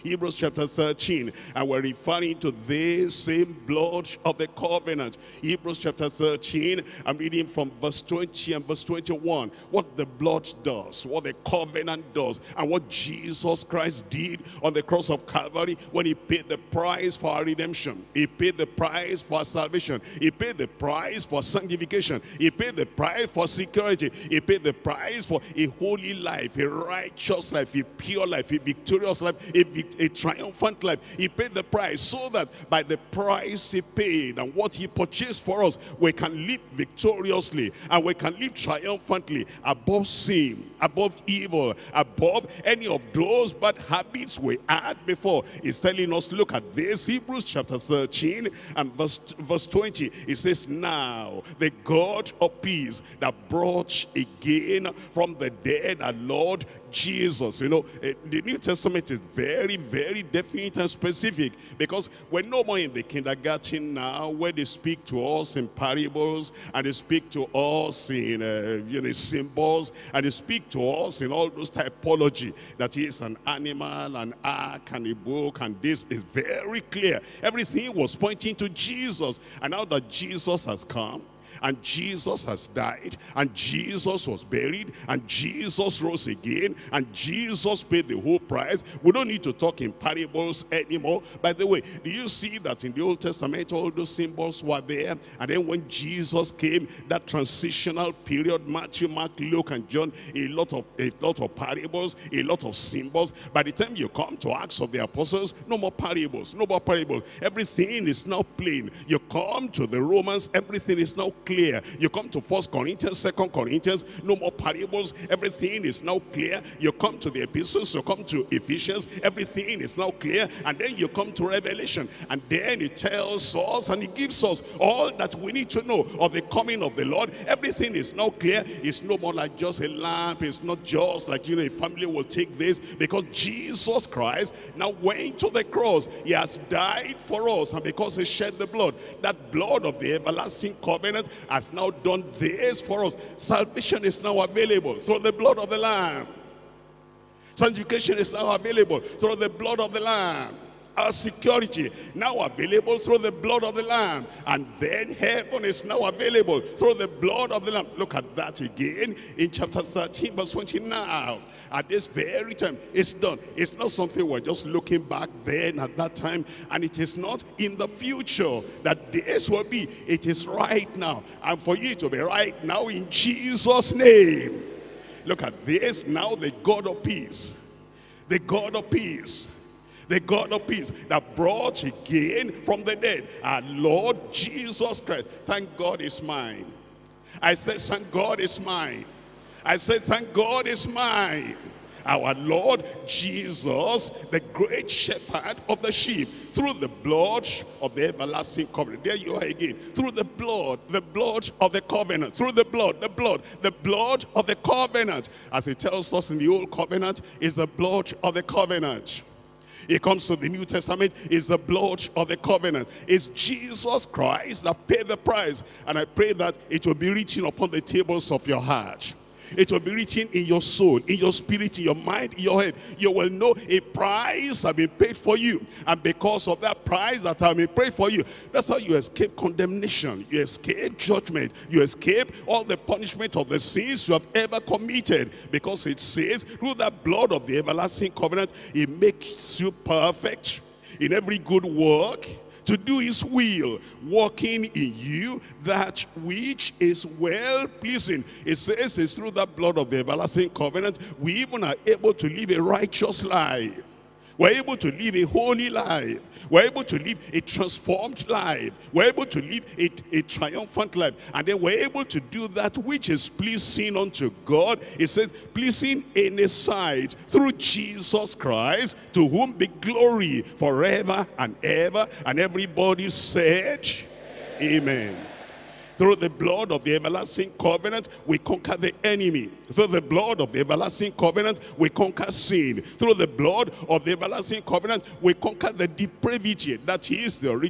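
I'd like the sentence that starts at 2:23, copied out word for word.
Salvation is now available through the blood of the Lamb.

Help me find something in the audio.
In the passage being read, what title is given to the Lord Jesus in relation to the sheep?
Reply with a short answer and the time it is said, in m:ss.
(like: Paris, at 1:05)
The great shepherd, at 3:14.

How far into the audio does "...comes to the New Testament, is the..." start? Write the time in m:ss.
3:30.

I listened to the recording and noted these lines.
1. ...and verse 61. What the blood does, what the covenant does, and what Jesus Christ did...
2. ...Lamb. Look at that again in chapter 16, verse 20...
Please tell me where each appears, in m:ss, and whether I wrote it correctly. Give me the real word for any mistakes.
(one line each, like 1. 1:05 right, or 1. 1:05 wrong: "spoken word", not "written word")
1. 0:08 wrong: "21", not "61"
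2. 2:37 wrong: "13", not "16".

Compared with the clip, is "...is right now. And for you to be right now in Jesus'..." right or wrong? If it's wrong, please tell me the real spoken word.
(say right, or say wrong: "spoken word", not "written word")
right.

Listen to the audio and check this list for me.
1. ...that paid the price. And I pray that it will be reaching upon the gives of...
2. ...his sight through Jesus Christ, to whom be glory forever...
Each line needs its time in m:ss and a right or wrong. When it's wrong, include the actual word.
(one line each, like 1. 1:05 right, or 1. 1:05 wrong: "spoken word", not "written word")
1. 3:34 wrong: "tables", not "gives"
2. 4:26 right.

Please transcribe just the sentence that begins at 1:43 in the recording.
By the time you come to Acts of the Apostles, no more parables, no more parables.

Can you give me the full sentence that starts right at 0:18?
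He he paid the price for salvation.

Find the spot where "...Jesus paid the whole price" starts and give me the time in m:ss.
1:27.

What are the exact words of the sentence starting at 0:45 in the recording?
He's telling us, look at this, Hebrews chapter 13 14 and verse, verse 20.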